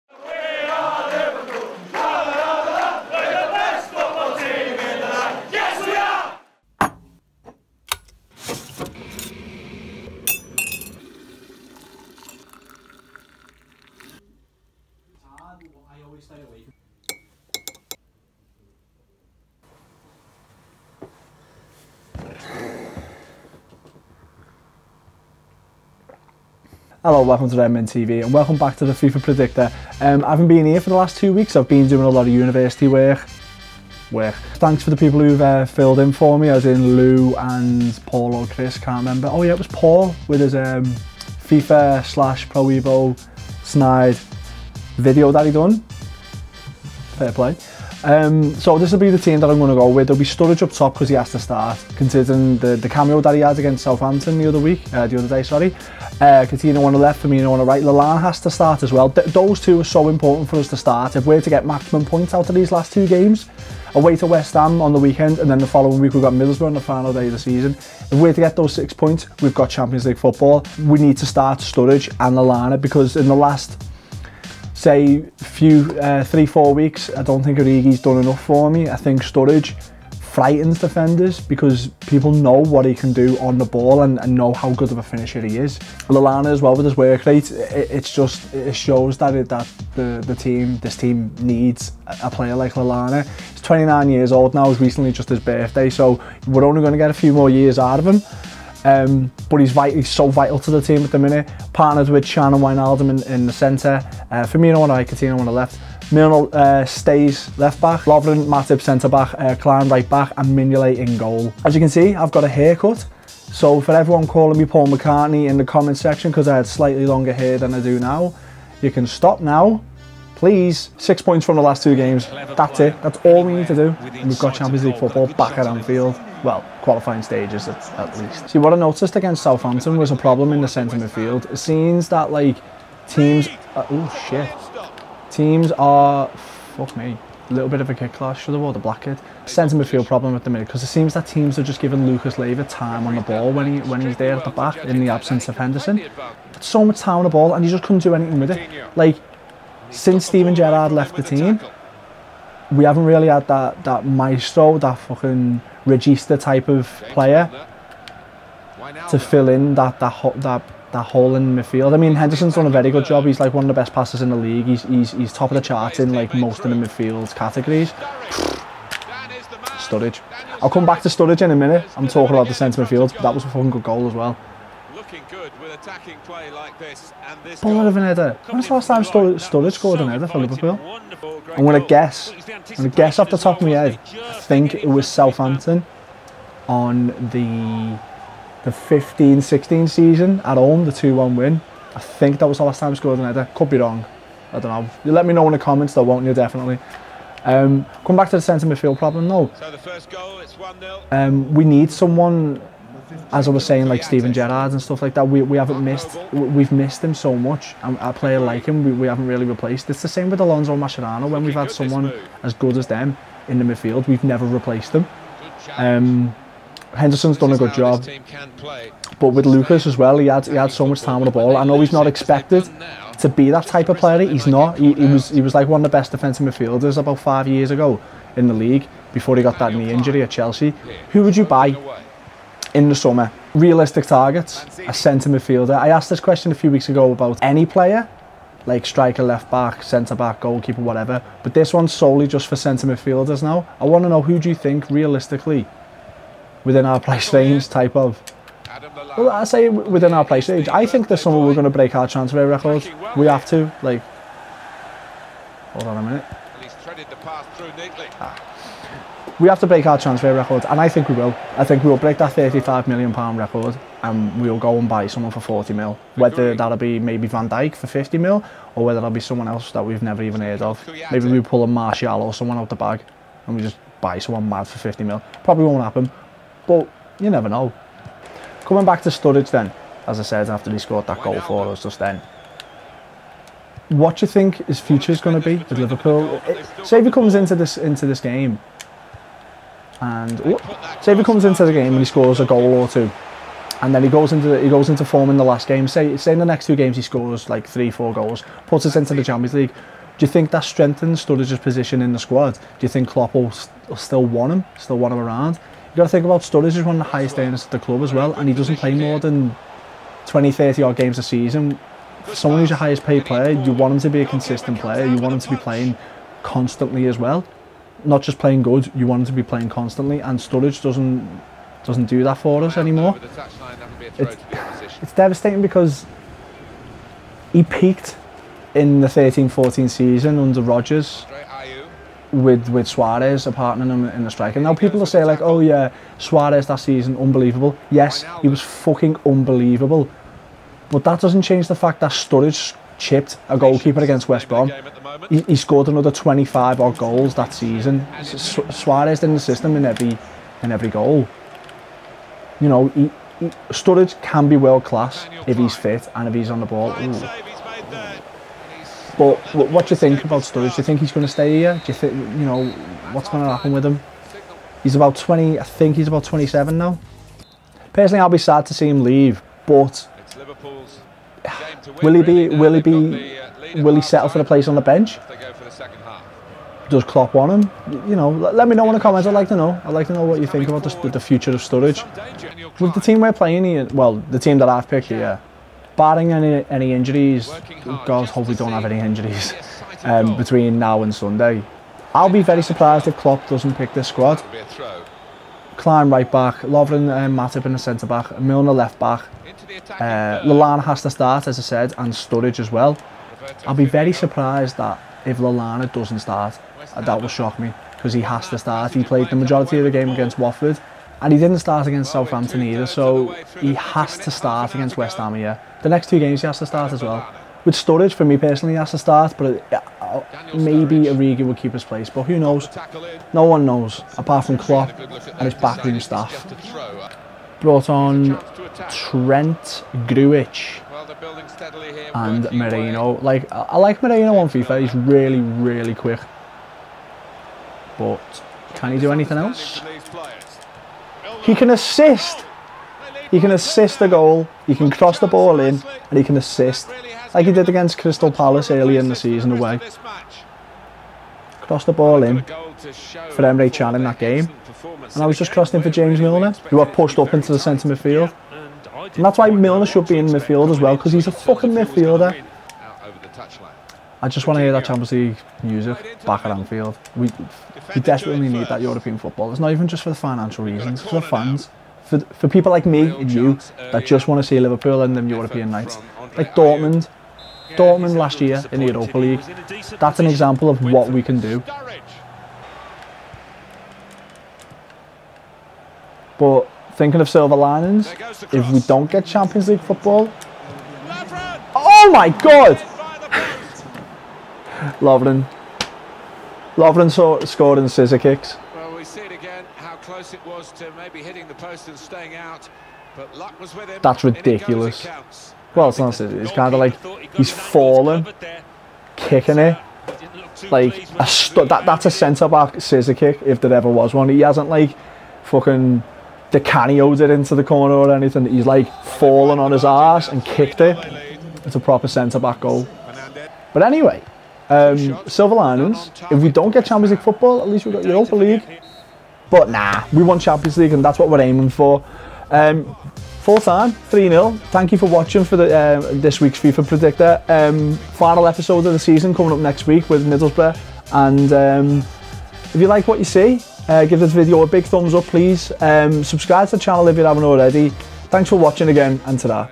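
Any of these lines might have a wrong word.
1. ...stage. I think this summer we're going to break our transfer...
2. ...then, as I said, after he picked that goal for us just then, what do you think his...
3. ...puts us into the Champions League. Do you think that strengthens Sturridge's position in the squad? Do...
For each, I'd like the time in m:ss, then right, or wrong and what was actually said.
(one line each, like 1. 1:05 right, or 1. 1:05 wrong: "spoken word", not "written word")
1. 4:10 right
2. 4:39 wrong: "scored", not "picked"
3. 4:58 right.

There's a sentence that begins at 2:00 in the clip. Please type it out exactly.
Please, six points from the last two games.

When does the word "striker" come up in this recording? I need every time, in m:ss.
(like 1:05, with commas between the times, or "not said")
3:58.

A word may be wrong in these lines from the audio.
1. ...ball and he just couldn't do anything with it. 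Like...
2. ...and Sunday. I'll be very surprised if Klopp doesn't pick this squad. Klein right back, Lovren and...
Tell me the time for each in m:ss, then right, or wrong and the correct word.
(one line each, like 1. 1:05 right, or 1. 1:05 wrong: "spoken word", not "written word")
1. 2:27 right
2. 6:31 right.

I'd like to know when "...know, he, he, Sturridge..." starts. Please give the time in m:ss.
5:52.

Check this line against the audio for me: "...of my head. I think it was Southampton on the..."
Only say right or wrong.
right.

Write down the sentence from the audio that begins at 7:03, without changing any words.
No one knows, apart from Klopp and his backroom staff.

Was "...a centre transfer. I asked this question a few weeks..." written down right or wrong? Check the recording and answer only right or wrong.
wrong.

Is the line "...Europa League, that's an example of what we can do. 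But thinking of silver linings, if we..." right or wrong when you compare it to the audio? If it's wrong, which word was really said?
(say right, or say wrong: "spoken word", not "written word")
right.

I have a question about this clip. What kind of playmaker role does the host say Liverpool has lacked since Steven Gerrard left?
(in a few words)
Regista.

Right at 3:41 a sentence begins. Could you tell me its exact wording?
I know he's not expected to be that type of player.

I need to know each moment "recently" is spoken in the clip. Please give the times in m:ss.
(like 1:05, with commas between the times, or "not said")
1:34.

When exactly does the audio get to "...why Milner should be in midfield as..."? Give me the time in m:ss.
7:39.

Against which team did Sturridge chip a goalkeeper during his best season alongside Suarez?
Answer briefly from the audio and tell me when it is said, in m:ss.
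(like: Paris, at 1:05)
West Brom, at 5:44.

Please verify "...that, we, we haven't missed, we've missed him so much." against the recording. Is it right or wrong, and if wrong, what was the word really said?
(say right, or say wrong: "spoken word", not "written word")
right.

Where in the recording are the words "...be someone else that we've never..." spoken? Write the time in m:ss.
4:29.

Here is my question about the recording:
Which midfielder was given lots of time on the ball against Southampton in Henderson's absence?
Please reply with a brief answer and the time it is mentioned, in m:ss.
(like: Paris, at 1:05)
Lucas Leiva, at 2:22.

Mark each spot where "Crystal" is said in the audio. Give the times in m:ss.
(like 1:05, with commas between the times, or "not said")
7:27.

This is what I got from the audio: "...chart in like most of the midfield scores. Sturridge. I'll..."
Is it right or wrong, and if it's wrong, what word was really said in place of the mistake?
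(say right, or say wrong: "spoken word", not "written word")
wrong: "categories", not "scores".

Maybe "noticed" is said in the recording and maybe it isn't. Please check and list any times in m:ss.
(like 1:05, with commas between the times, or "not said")
2:08.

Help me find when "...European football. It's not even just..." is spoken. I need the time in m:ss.
7:48.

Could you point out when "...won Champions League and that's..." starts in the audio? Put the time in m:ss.
8:50.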